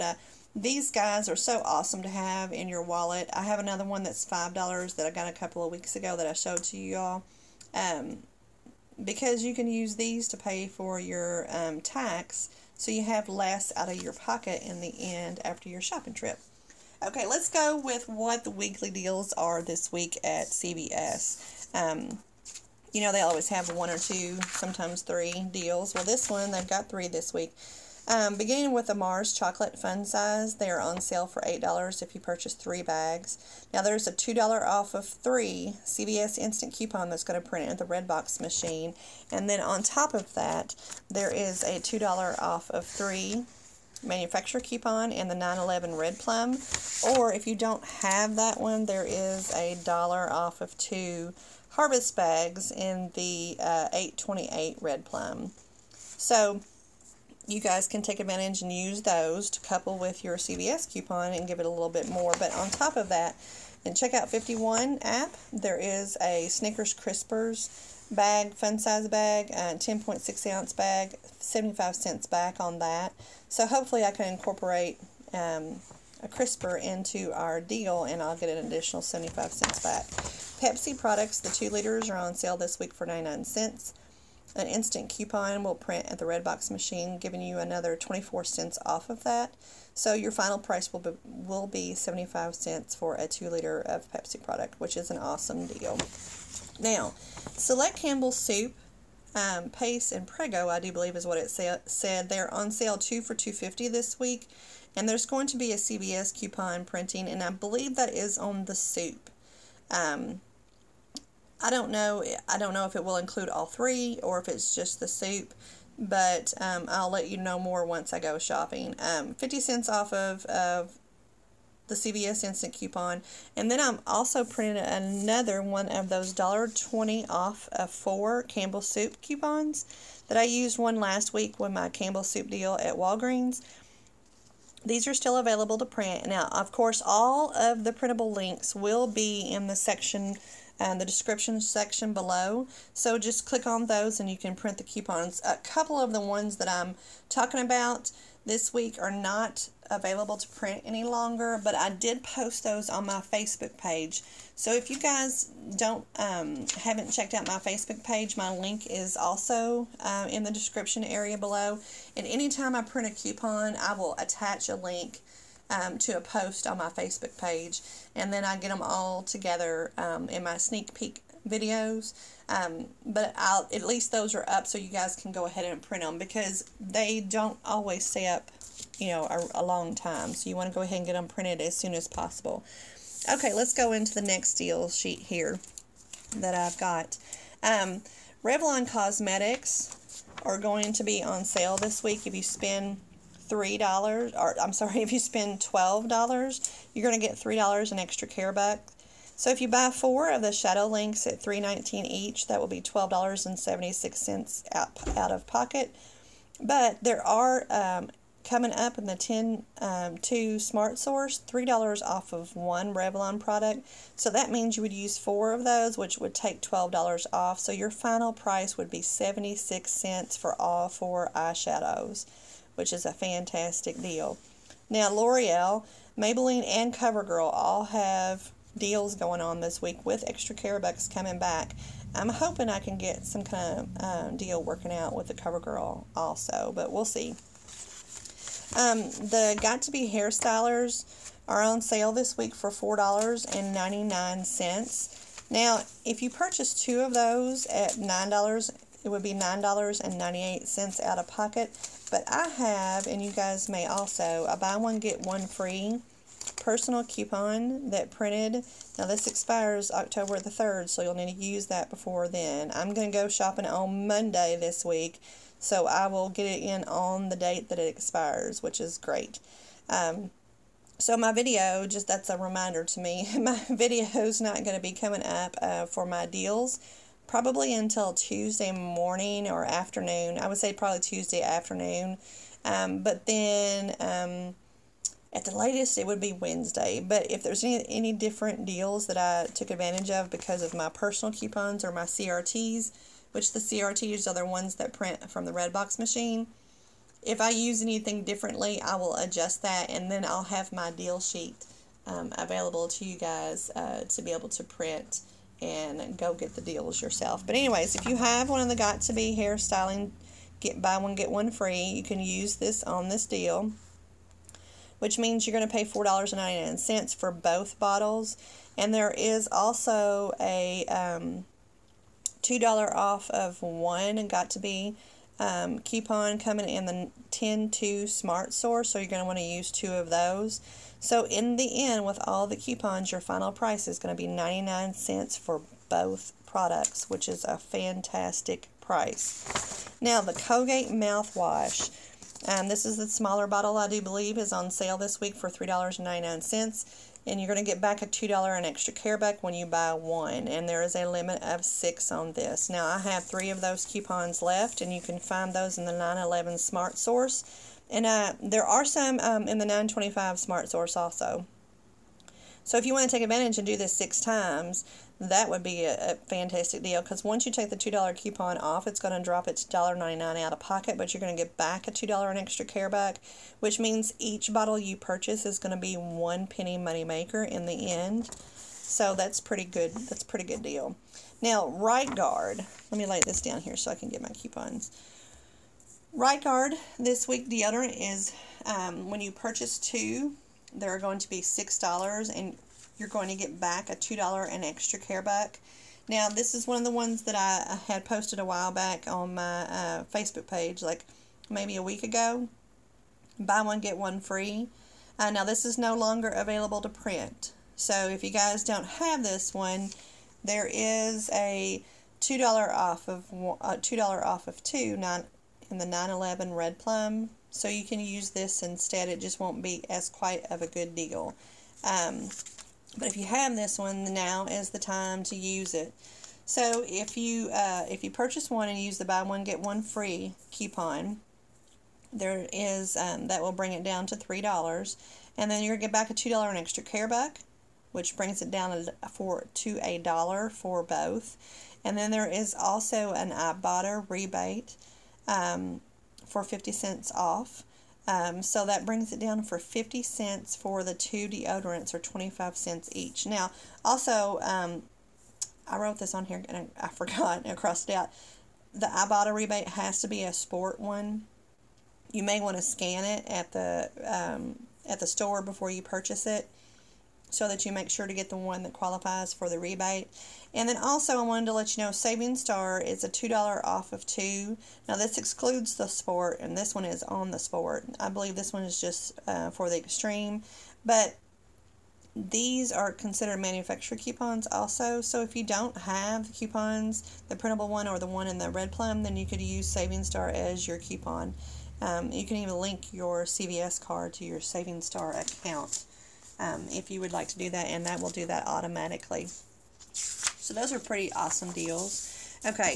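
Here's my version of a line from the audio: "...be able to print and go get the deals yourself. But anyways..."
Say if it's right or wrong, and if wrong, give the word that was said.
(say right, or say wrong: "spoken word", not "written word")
right.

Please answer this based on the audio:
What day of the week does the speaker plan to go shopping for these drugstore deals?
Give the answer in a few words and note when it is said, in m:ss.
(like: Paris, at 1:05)
Monday, at 4:24.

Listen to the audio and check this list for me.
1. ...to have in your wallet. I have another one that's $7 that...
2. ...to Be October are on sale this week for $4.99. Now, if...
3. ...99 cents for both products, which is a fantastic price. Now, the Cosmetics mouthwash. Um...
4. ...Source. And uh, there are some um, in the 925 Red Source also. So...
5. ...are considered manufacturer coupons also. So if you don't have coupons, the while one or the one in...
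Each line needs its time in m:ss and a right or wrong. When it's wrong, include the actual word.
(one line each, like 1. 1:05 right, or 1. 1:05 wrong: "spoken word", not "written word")
1. 0:02 wrong: "5", not "7"
2. 3:59 wrong: "Hairstylers", not "October"
3. 5:34 wrong: "Colgate", not "Cosmetics"
4. 5:56 wrong: "Smart", not "Red"
5. 8:02 wrong: "printable", not "while".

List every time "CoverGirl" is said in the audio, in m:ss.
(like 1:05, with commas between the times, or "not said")
3:46, 3:55.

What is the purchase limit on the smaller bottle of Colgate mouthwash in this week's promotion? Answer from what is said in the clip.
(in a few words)
6.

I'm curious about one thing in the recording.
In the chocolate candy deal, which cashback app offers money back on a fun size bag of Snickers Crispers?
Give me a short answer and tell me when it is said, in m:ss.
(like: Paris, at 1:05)
Checkout 51, at 1:03.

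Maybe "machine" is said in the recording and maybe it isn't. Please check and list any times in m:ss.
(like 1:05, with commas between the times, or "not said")
0:38, 1:26, 4:55.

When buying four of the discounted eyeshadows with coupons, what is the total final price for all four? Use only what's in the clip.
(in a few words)
76 cents.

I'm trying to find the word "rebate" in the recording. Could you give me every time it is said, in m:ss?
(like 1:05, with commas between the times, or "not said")
7:24, 7:39, 7:49.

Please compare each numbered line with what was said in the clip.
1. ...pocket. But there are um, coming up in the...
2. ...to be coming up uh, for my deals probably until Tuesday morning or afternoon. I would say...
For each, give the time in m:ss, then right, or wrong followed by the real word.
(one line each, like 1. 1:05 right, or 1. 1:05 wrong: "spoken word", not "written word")
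1. 3:25 right
2. 4:34 right.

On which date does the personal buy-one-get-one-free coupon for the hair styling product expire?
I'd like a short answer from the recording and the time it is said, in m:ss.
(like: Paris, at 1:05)
October 3rd, at 4:19.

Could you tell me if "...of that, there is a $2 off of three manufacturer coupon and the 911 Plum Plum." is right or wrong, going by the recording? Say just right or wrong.
wrong.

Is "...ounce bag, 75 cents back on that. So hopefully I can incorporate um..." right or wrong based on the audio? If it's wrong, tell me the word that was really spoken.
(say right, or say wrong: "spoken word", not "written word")
right.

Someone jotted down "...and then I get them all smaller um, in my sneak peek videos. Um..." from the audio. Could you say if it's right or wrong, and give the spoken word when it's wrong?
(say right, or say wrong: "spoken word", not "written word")
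wrong: "together", not "smaller".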